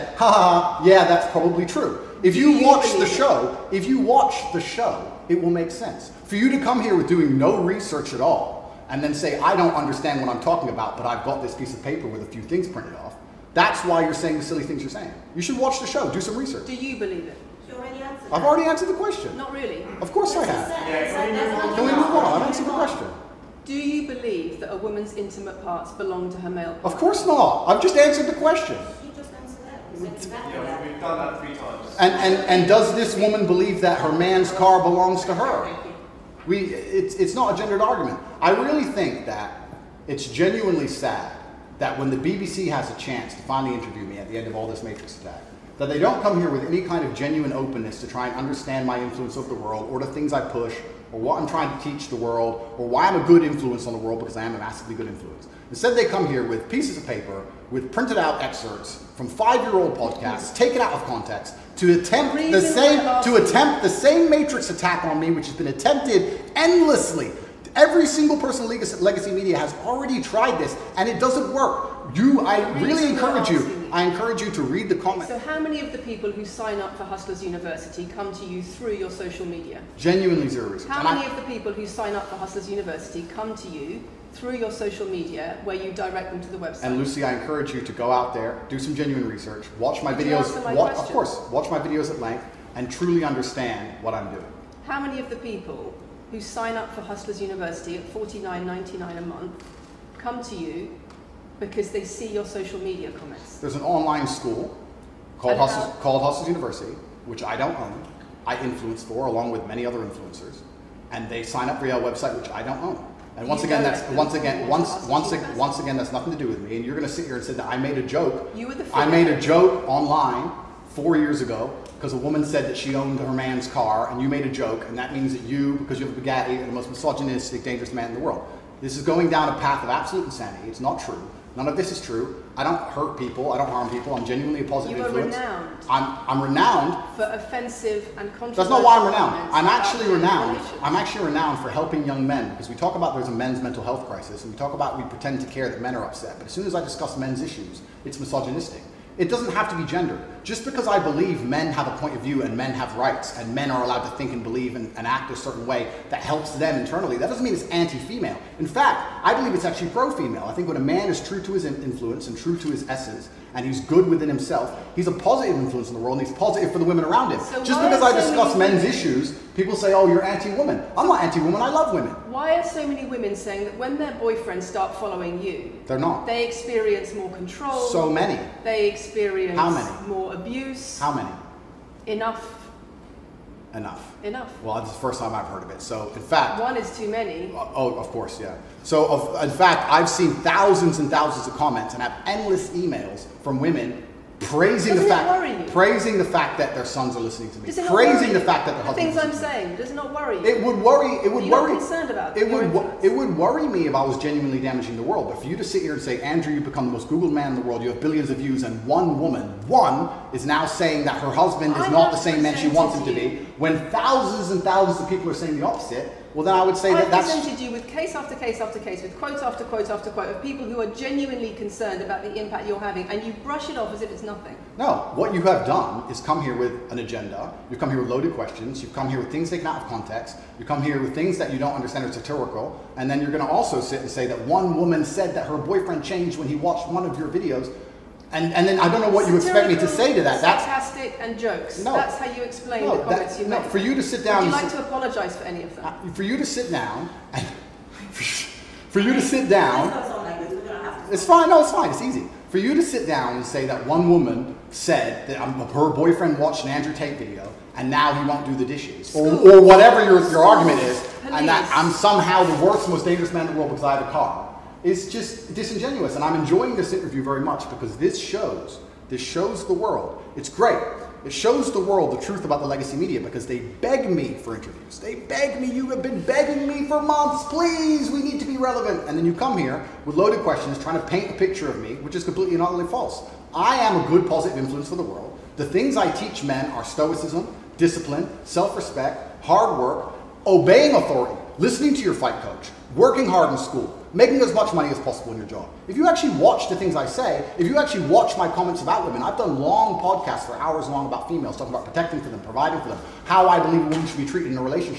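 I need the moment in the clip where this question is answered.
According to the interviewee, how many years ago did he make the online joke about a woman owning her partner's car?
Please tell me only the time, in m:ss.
2:00.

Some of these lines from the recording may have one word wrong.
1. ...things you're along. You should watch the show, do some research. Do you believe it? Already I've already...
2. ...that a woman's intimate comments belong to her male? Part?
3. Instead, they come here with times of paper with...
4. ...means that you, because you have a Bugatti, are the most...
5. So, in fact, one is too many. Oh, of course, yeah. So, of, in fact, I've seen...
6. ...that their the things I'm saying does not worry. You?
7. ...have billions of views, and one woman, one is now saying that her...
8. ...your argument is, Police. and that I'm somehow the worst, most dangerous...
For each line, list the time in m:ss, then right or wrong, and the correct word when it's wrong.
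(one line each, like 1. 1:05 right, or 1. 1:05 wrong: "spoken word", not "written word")
1. 0:14 wrong: "saying", not "along"
2. 0:24 wrong: "parts", not "comments"
3. 0:55 wrong: "pieces", not "times"
4. 2:05 right
5. 3:05 right
6. 3:18 right
7. 3:27 right
8. 4:20 right.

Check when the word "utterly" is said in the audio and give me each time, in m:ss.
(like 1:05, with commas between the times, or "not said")
4:42.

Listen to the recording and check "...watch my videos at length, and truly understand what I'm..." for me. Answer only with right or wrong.
right.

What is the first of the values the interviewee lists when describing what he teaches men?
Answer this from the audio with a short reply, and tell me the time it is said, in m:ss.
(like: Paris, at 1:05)
stoicism, at 4:46.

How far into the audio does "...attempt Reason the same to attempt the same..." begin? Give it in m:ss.
1:01.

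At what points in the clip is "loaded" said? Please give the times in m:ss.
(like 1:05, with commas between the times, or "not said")
3:48, 4:40.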